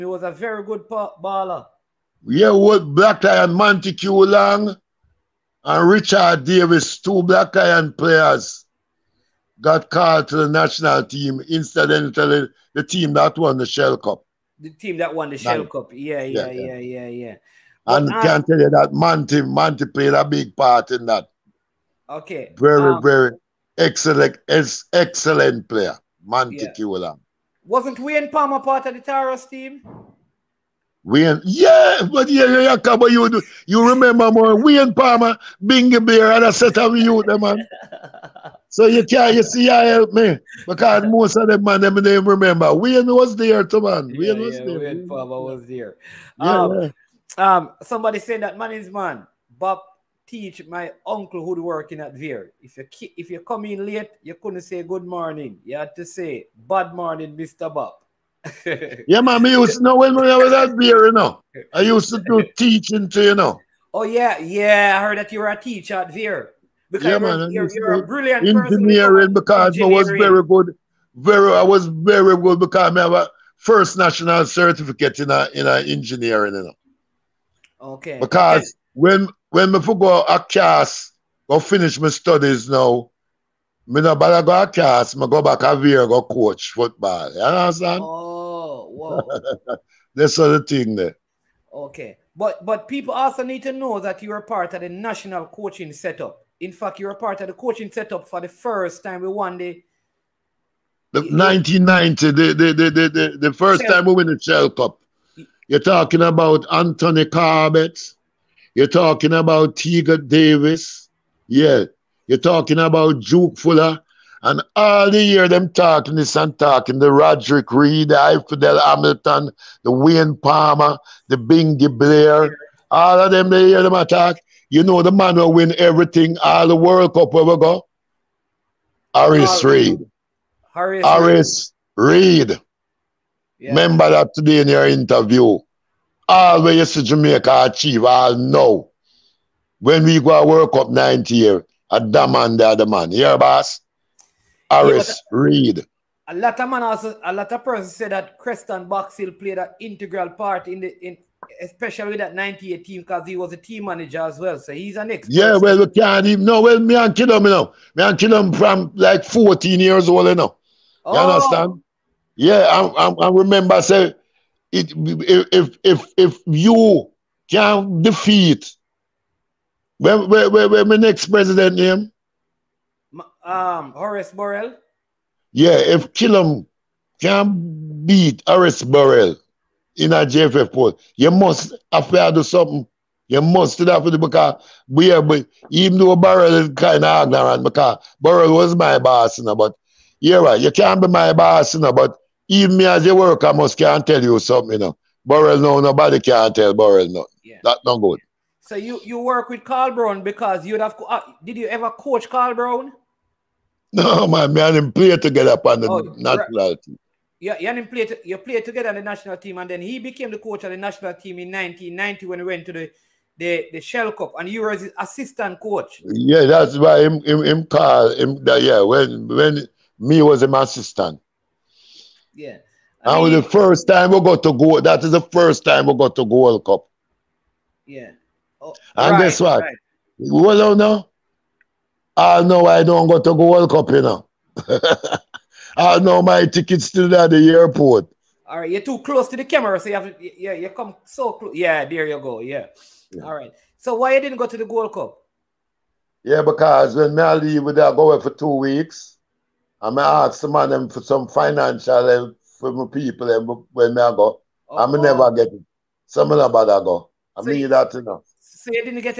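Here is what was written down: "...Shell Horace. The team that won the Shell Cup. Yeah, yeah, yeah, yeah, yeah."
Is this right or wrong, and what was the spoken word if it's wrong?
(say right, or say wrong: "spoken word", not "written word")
wrong: "Cup", not "Horace".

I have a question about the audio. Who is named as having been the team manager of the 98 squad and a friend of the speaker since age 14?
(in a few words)
Crenston Boxhill.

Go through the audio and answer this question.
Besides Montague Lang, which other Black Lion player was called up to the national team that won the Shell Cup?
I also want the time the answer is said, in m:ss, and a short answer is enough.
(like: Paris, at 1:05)
Richard Davis, at 0:05.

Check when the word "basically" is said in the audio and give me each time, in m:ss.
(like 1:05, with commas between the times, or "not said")
not said.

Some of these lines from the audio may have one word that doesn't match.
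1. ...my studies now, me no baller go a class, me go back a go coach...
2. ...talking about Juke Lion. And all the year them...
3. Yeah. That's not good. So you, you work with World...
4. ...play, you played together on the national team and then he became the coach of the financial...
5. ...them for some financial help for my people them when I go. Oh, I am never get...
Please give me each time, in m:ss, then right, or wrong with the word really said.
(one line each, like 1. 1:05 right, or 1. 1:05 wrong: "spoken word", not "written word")
1. 1:21 wrong: "bother", not "baller"
2. 1:52 wrong: "Fuller", not "Lion"
3. 3:17 wrong: "Carl", not "World"
4. 3:27 wrong: "national", not "financial"
5. 4:10 right.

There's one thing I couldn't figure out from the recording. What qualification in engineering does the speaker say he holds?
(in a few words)
First national certificate.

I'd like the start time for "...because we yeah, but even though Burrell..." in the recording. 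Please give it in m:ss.
3:04.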